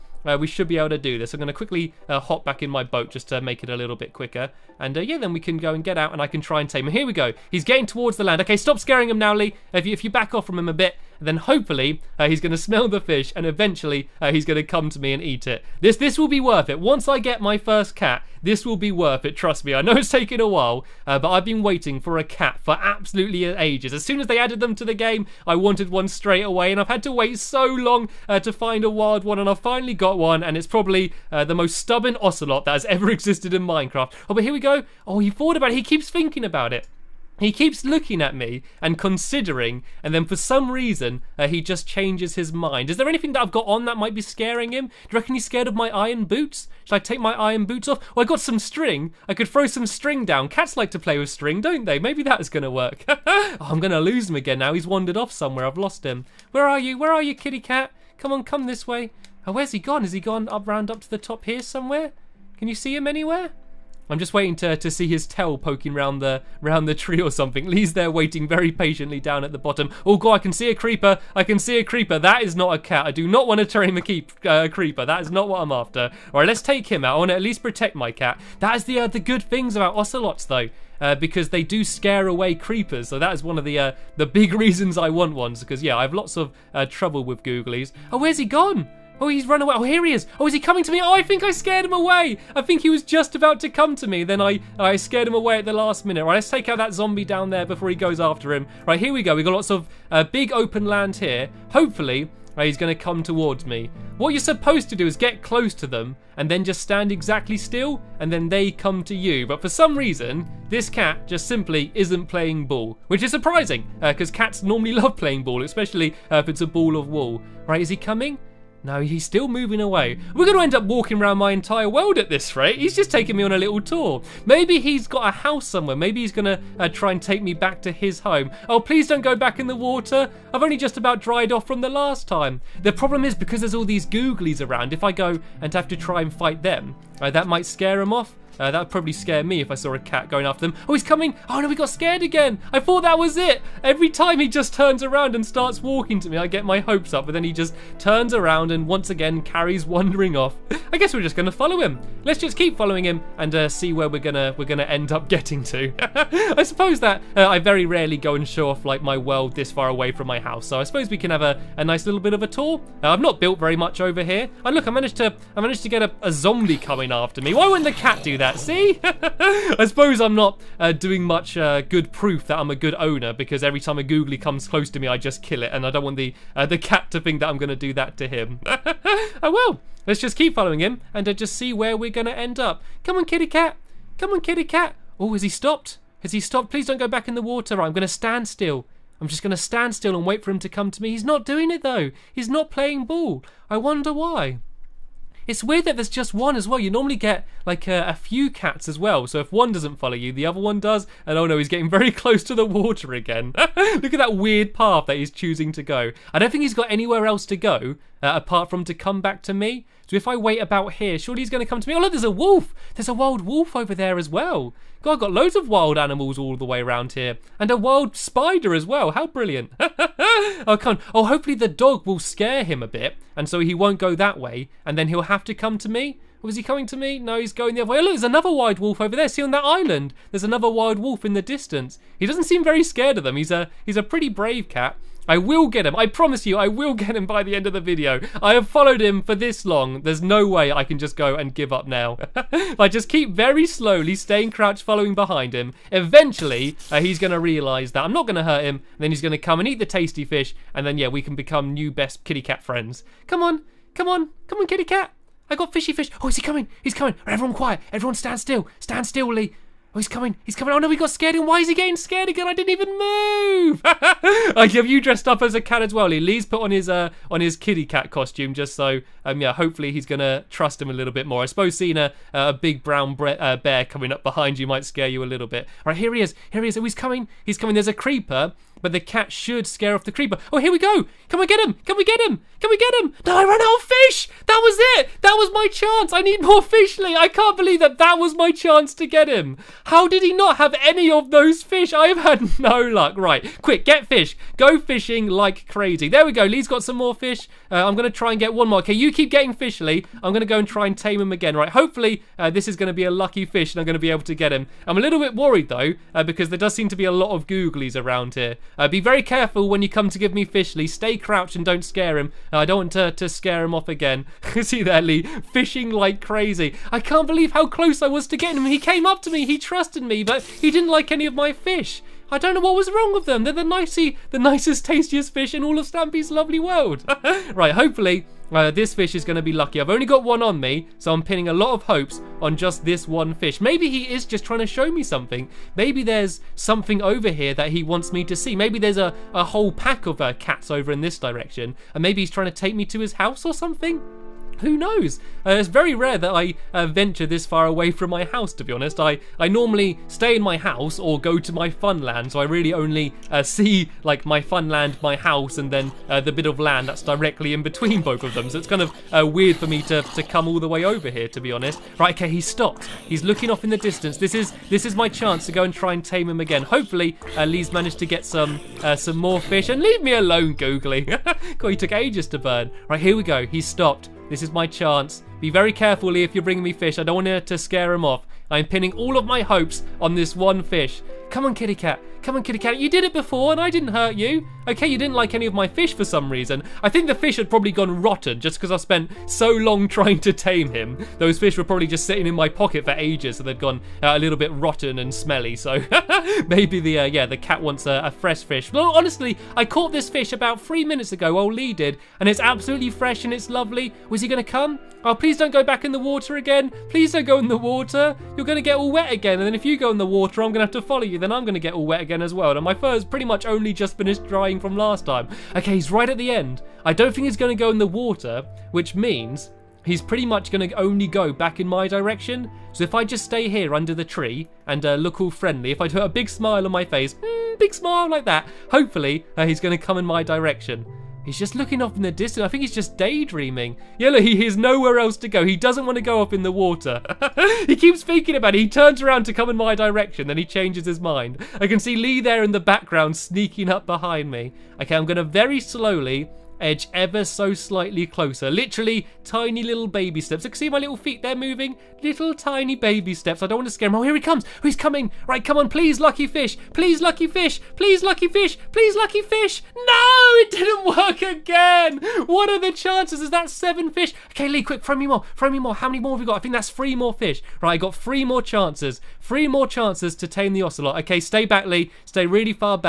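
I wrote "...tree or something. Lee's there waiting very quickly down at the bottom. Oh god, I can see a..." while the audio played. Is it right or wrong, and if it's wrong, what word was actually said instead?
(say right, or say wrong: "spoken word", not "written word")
wrong: "patiently", not "quickly".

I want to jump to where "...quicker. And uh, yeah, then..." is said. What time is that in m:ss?
0:04.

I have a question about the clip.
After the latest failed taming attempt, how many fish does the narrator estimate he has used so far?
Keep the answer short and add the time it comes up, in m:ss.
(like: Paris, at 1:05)
7, at 7:43.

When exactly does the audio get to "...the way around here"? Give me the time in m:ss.
3:36.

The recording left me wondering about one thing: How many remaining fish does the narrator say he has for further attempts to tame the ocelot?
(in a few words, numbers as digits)
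3.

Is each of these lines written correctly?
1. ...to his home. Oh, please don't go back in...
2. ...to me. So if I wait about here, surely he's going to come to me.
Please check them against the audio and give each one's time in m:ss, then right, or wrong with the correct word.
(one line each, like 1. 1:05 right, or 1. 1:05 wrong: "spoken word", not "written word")
1. 2:07 right
2. 3:29 right.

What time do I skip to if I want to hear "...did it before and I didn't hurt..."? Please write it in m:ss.
6:22.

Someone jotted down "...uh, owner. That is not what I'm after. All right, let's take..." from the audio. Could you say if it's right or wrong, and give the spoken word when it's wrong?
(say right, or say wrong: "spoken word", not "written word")
wrong: "creeper", not "owner".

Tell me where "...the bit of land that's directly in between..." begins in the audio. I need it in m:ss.
5:56.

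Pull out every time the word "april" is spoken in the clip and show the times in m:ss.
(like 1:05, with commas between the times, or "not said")
not said.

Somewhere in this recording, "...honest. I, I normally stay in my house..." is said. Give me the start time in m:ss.
5:48.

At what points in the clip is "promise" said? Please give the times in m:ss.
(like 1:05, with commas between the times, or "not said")
3:56.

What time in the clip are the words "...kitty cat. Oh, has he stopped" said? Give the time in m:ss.
3:04.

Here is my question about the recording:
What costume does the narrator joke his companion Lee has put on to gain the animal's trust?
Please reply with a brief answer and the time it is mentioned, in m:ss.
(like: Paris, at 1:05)
Kitty cat costume, at 4:27.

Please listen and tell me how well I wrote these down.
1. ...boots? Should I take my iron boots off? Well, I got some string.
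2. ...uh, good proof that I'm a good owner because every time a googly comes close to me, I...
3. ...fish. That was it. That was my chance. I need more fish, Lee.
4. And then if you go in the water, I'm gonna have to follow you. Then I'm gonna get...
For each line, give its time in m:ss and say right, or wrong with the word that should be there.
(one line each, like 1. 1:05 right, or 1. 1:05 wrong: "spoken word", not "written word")
1. 0:46 right
2. 2:51 right
3. 4:43 right
4. 6:49 right.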